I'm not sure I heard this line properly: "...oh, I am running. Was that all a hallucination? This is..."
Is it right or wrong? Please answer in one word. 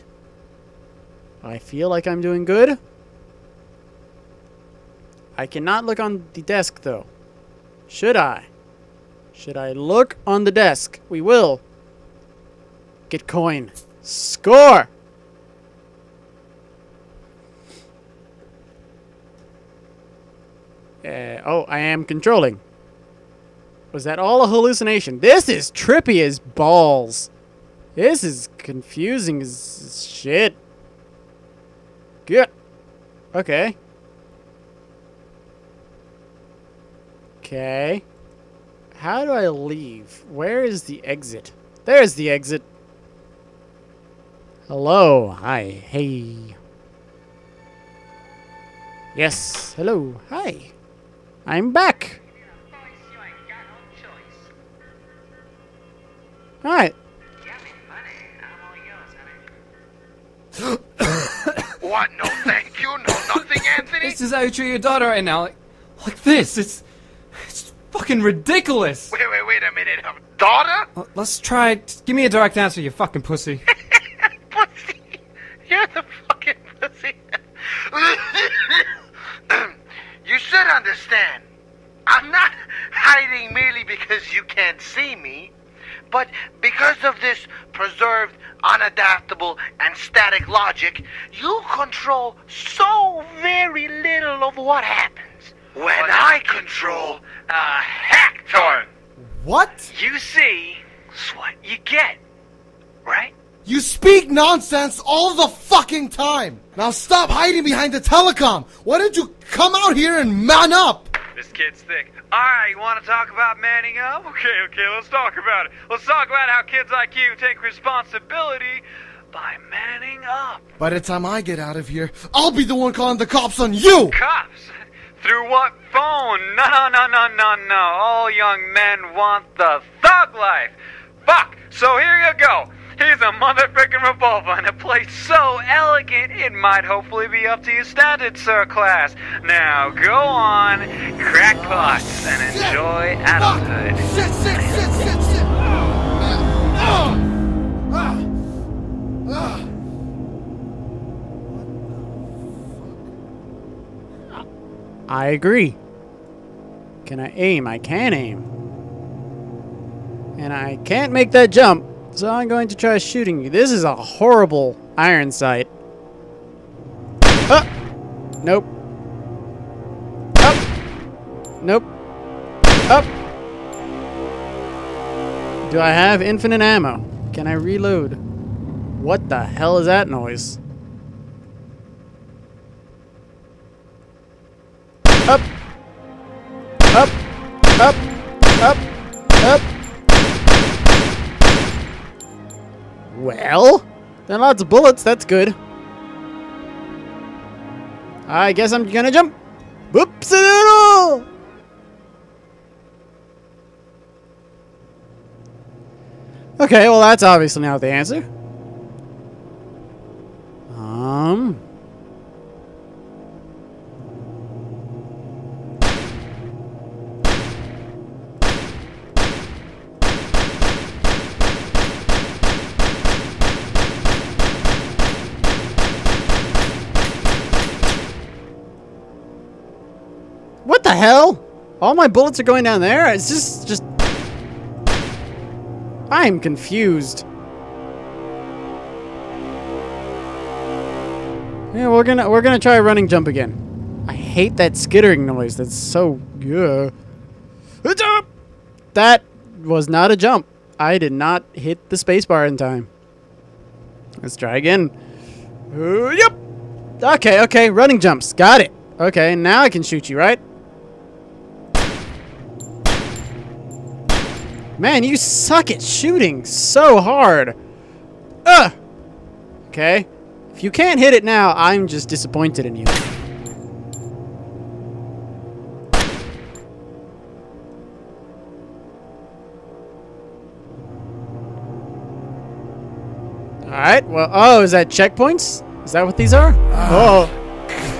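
wrong.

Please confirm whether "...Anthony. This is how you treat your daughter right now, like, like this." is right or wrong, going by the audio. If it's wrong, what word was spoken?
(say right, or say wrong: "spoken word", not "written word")
right.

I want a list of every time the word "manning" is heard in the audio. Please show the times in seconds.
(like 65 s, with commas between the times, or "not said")
113 s, 119 s.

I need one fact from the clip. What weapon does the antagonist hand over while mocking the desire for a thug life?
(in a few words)
revolver.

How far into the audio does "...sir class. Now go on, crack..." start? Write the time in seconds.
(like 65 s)
138 s.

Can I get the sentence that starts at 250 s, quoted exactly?
I did not hit the spacebar in time.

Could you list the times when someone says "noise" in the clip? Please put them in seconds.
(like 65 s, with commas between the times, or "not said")
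180 s, 245 s.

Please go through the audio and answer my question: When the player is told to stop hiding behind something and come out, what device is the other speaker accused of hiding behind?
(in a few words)
the telecom.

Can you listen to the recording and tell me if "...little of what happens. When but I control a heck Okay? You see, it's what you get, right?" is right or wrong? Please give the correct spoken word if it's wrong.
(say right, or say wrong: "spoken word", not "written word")
wrong: "What", not "Okay".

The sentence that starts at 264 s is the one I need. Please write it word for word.
Man, you suck at shooting so hard.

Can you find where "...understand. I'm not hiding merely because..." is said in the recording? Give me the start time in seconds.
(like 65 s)
80 s.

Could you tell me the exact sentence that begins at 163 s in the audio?
This is a horrible iron sight.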